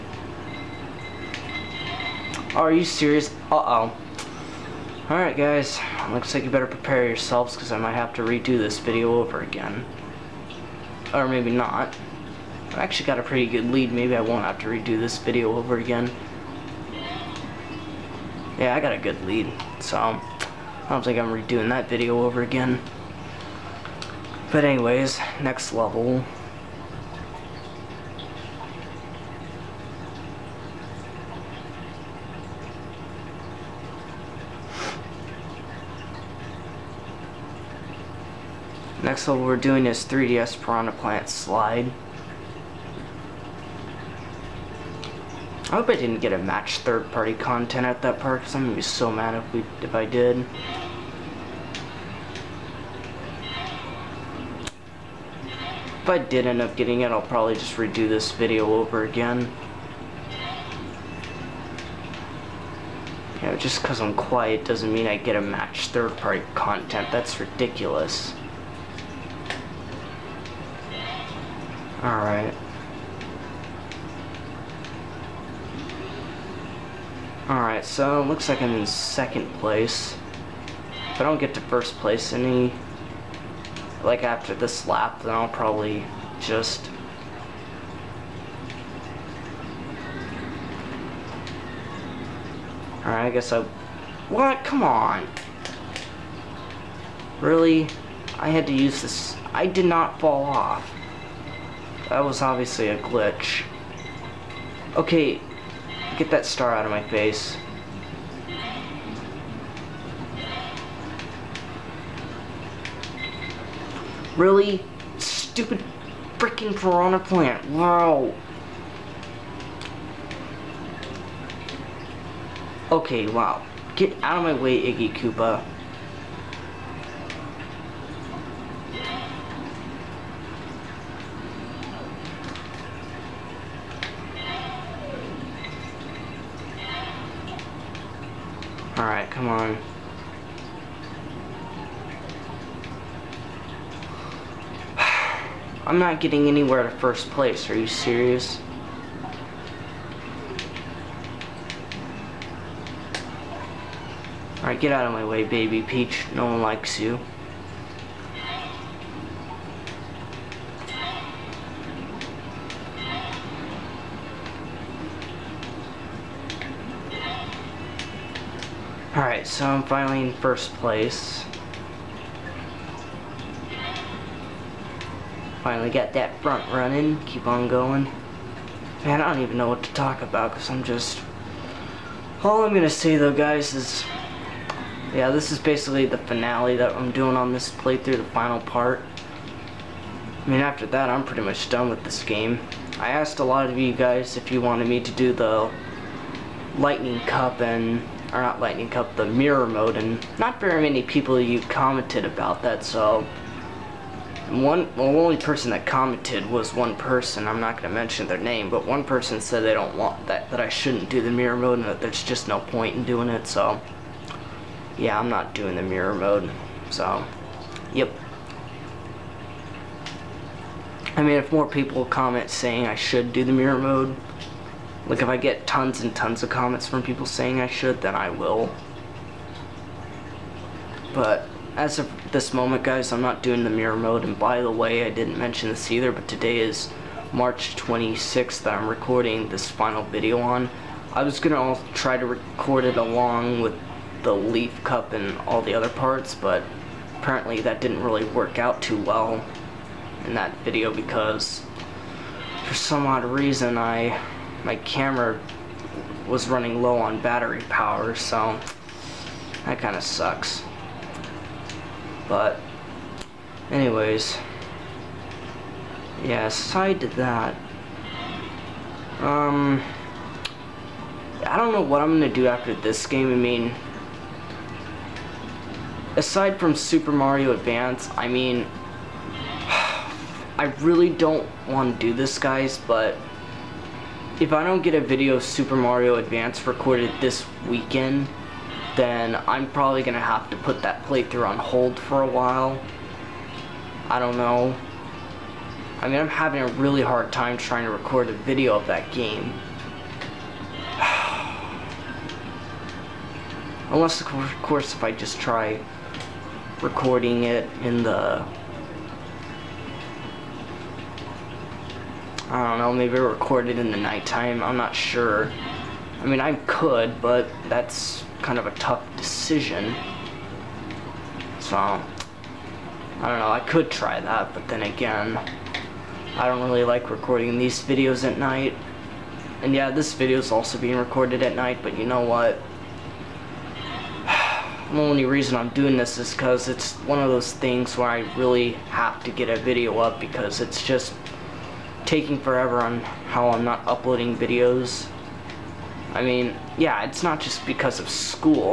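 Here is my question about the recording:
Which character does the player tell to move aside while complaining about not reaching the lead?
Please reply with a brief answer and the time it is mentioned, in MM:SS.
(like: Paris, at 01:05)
Iggy Koopa, at 02:04.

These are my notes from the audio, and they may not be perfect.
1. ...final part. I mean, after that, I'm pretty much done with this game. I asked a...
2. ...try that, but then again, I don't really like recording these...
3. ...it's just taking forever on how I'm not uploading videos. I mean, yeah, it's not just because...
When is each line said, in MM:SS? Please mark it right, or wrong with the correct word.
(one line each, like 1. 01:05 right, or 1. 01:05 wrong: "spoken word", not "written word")
1. 03:08 right
2. 05:23 right
3. 05:40 right.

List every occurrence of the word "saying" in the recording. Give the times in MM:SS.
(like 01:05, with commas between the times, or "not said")
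03:42, 03:47.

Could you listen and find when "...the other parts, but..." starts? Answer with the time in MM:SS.
04:05.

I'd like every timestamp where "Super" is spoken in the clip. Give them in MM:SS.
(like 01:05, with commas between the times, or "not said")
04:36, 04:45.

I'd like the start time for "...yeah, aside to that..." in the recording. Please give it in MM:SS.
04:26.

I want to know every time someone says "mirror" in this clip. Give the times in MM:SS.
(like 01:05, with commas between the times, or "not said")
03:19, 03:31, 03:35, 03:43, 03:53.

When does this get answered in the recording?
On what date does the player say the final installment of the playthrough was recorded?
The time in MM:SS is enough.
03:57.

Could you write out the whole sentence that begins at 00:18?
Yeah, I got a good lead, so I don't think I'm redoing that video over again.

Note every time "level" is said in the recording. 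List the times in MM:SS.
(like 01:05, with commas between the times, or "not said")
00:25, 00:39.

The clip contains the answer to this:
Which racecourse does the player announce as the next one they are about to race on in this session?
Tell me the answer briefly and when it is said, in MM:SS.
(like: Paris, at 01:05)
3DS Piranha Plant Slide, at 00:40.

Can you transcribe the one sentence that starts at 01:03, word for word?
You know, just because I'm quiet doesn't mean I get a match third-party content.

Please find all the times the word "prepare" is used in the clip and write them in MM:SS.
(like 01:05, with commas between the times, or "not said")
00:06.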